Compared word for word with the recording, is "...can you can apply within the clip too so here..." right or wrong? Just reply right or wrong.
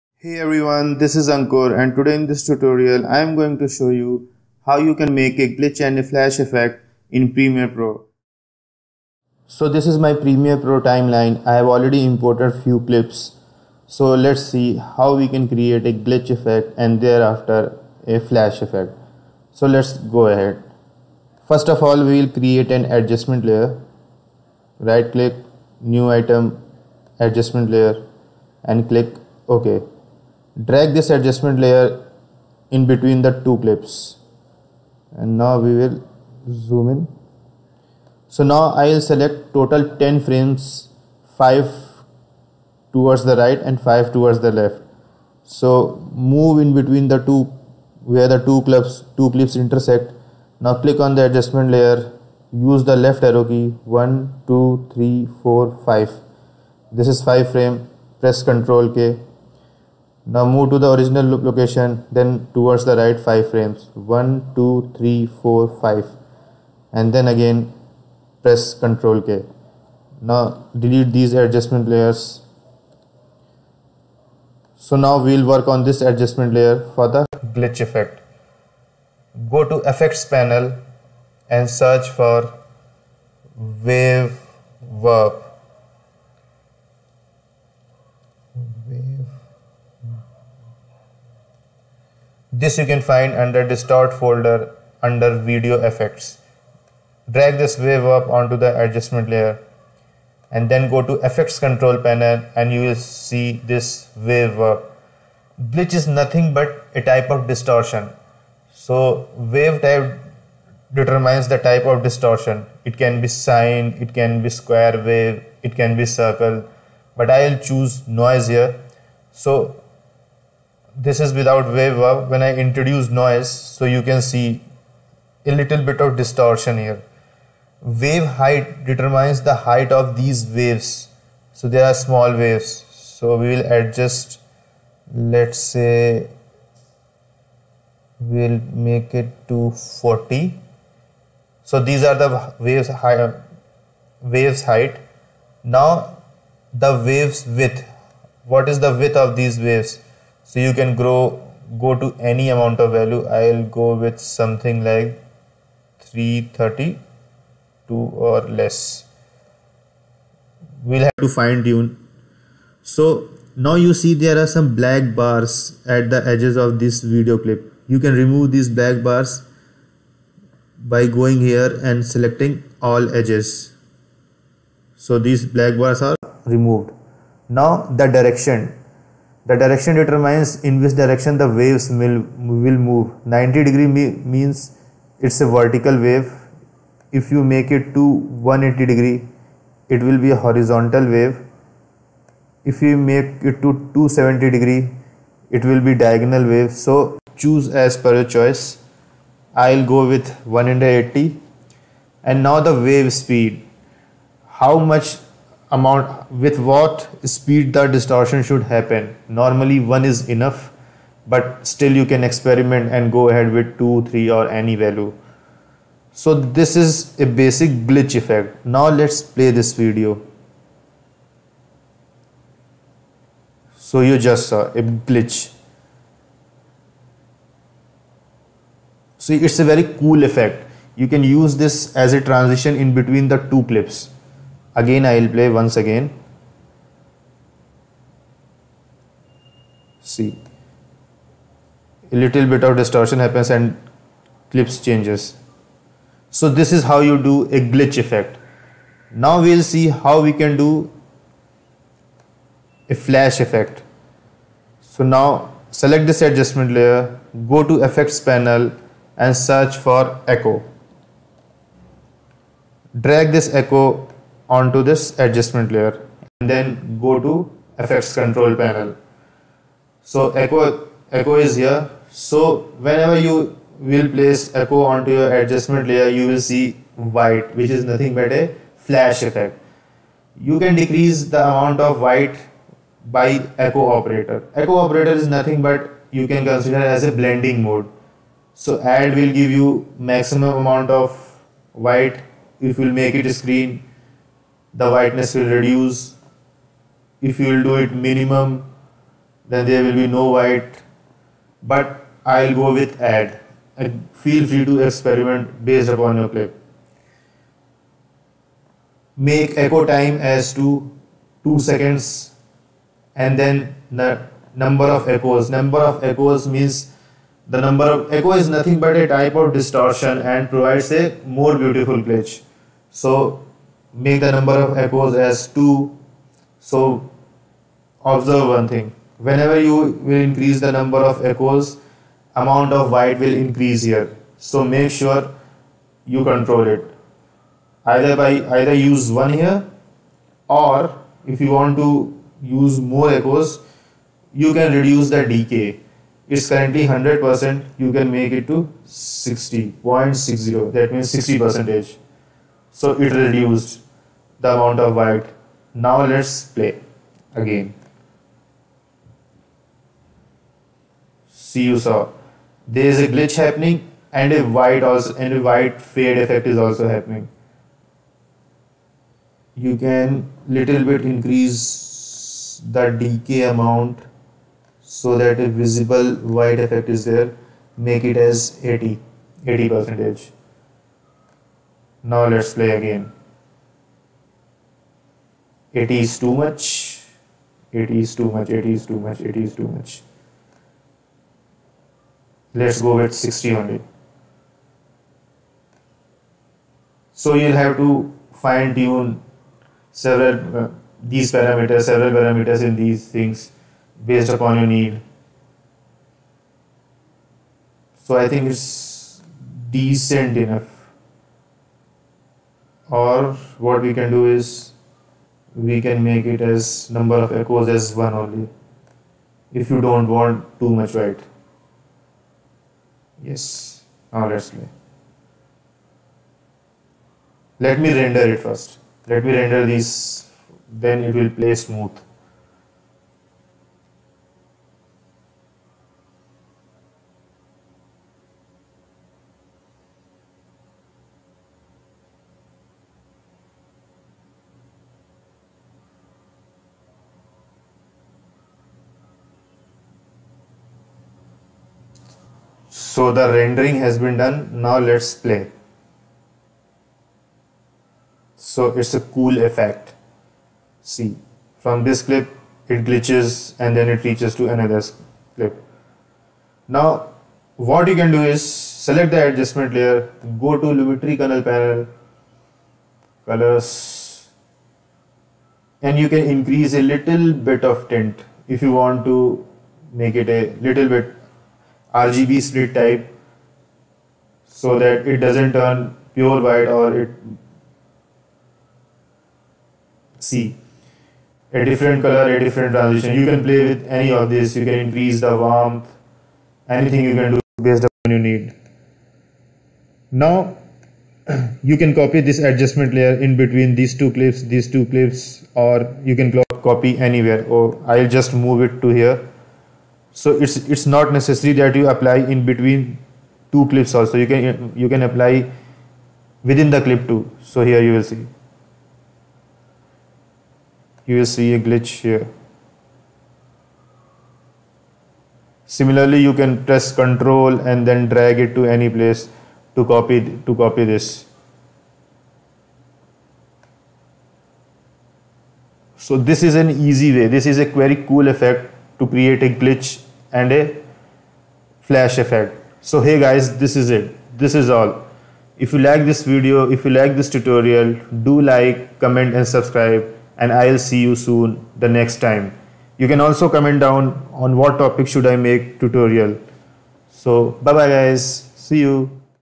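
right.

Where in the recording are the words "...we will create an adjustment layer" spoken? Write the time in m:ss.
0:22.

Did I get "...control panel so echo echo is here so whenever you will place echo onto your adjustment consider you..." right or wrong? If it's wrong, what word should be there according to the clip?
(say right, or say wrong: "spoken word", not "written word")
wrong: "layer", not "consider".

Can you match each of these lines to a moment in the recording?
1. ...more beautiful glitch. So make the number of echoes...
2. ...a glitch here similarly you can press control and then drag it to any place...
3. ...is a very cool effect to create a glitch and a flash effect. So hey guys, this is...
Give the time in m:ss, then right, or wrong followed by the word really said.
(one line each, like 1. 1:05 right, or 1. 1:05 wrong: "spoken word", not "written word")
1. 5:21 right
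2. 8:41 right
3. 8:57 right.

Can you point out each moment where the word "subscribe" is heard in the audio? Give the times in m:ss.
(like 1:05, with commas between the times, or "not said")
9:09.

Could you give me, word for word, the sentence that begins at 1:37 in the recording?
Drag this wave warp onto the adjustment layer and then go to effects control panel and you will see this wave warp.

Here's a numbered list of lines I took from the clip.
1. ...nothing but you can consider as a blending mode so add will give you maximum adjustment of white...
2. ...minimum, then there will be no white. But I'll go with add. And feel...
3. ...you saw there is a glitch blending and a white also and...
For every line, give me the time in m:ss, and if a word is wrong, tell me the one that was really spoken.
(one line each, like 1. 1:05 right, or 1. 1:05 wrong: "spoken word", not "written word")
1. 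4:45 wrong: "amount", not "adjustment"
2. 4:57 right
3. 6:01 wrong: "happening", not "blending".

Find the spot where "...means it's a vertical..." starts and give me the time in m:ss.
3:03.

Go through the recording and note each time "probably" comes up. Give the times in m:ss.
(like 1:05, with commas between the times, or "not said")
not said.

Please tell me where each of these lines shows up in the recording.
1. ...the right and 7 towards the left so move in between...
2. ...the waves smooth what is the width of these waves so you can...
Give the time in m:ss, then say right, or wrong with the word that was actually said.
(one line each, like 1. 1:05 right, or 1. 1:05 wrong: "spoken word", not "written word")
1. 0:43 wrong: "5", not "7"
2. 2:26 wrong: "width", not "smooth".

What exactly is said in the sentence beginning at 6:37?
So you'll have to fine tune several uh, these parameters, several parameters in these things based upon your need.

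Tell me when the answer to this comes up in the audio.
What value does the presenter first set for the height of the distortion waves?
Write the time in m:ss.
2:19.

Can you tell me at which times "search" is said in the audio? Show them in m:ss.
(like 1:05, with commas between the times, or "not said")
1:21, 4:19.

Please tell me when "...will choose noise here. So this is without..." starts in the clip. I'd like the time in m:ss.
1:57.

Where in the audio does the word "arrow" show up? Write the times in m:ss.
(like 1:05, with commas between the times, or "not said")
0:53.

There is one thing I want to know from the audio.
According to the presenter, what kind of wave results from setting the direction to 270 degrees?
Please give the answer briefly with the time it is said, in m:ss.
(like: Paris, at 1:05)
Diagonal, at 3:15.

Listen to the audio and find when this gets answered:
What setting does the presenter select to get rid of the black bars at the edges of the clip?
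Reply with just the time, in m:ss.
2:52.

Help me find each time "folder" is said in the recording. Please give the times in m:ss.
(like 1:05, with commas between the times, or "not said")
1:34.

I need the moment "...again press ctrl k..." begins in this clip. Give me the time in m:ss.
1:07.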